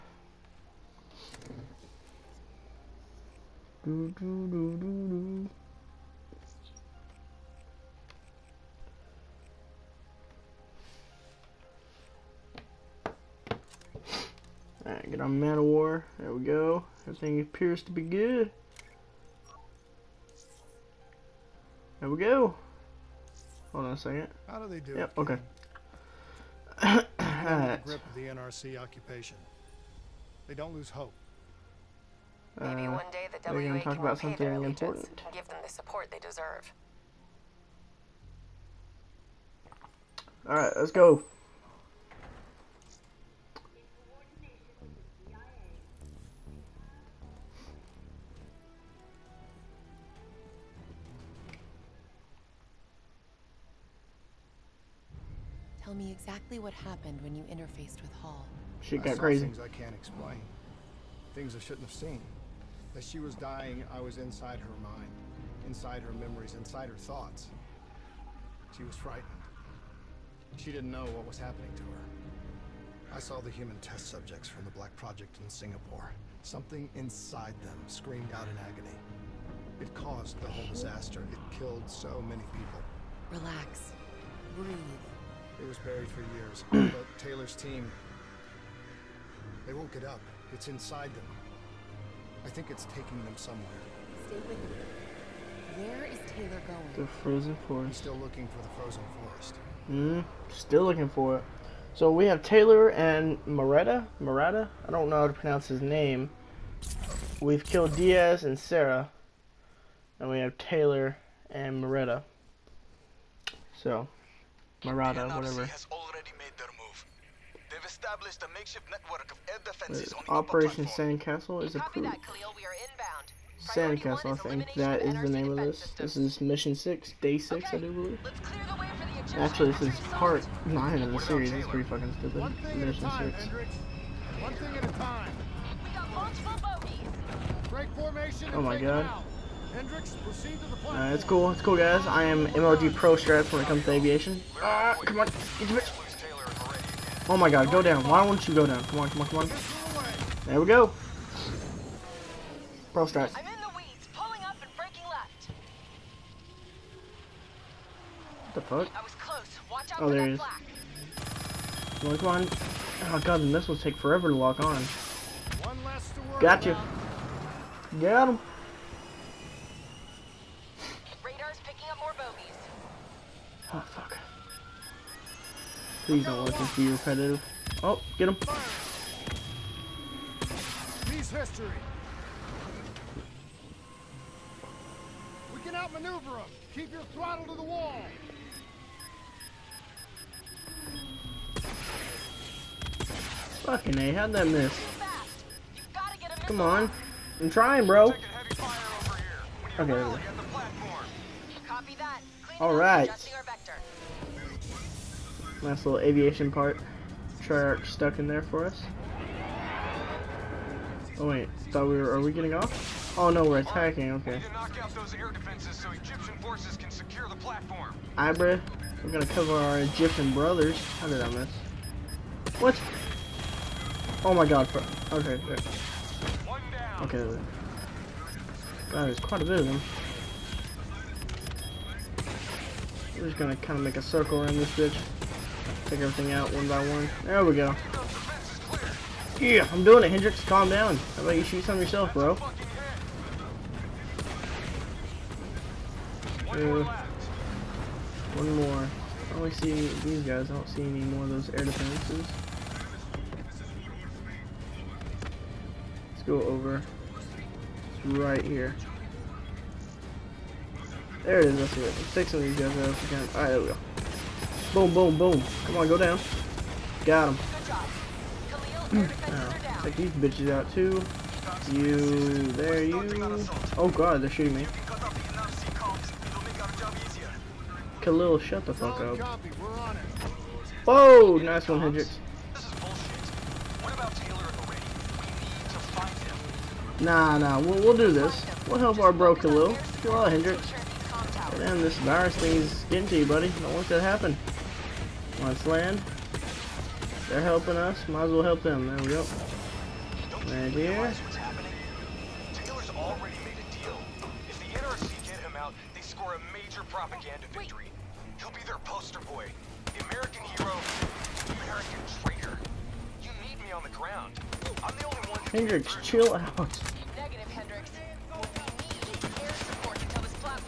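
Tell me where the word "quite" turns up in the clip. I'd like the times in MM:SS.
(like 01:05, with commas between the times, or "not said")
03:49.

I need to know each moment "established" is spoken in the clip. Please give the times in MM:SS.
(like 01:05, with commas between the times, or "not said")
01:57.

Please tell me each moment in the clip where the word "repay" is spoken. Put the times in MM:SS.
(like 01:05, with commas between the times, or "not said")
00:34.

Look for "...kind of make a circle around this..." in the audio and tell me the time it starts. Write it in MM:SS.
03:53.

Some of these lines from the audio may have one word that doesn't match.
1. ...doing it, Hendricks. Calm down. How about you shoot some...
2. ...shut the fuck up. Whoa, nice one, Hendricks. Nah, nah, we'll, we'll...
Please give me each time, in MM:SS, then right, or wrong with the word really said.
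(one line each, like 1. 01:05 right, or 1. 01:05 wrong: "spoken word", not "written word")
1. 03:59 right
2. 04:38 right.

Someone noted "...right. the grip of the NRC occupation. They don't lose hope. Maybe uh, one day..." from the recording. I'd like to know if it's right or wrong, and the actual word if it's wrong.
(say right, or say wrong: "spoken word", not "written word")
right.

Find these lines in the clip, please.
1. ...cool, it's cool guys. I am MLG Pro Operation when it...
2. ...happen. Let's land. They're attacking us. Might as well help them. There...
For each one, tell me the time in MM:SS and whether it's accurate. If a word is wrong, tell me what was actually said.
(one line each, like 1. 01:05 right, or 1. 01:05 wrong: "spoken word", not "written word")
1. 02:21 wrong: "Strats", not "Operation"
2. 04:54 wrong: "helping", not "attacking".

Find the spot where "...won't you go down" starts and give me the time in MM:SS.
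02:28.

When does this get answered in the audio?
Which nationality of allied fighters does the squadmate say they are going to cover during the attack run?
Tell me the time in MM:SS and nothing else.
03:39.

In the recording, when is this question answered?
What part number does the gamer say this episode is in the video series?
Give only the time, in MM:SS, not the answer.
02:10.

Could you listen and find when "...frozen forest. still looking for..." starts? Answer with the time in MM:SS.
01:37.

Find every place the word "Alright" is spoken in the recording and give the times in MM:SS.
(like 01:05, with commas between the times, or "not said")
00:14, 00:40, 03:22, 04:23.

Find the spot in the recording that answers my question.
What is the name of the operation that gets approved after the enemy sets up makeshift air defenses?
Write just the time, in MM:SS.
02:00.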